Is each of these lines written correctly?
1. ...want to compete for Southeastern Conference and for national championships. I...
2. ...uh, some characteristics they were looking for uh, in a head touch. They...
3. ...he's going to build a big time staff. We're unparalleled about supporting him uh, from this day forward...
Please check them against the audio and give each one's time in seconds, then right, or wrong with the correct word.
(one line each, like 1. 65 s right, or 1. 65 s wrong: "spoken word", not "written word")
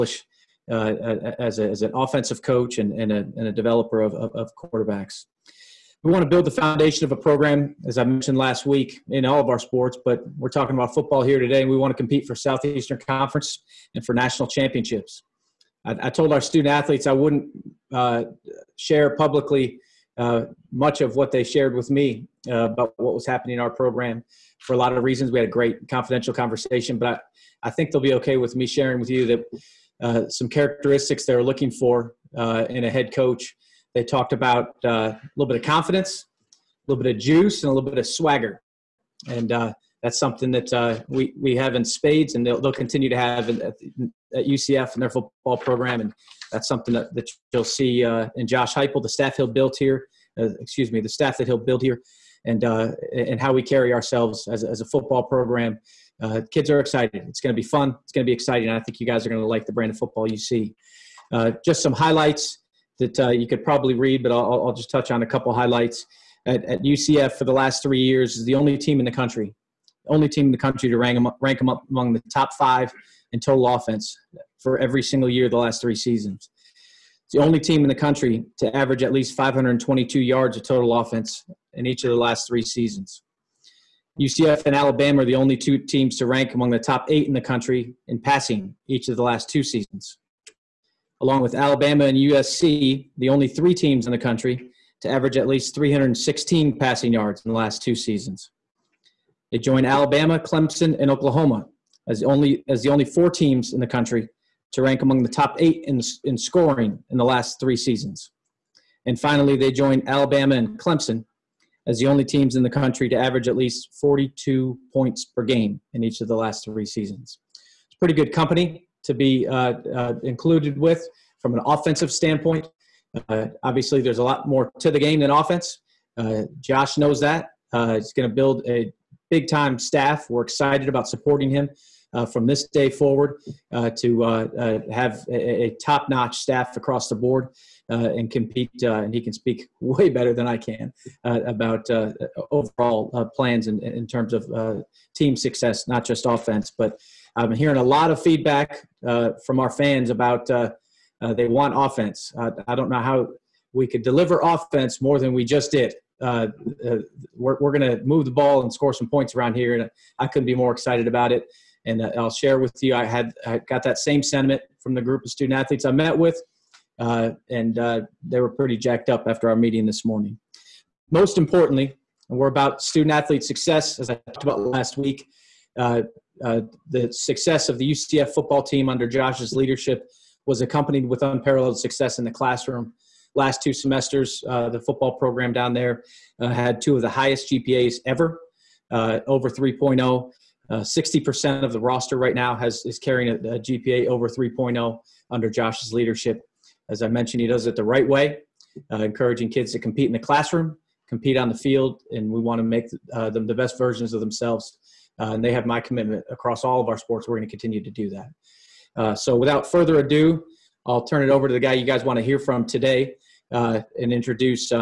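1. 11 s right
2. 30 s wrong: "coach", not "touch"
3. 127 s wrong: "excited", not "unparalleled".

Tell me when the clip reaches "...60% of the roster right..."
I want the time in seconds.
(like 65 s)
190 s.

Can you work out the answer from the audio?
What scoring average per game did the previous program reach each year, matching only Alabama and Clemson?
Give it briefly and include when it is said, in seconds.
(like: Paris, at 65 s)
42 points, at 113 s.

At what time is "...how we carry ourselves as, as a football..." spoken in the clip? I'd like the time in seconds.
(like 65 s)
53 s.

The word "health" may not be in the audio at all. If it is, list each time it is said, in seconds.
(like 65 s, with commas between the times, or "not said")
not said.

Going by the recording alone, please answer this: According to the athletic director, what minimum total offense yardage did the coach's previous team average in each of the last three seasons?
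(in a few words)
522 yards.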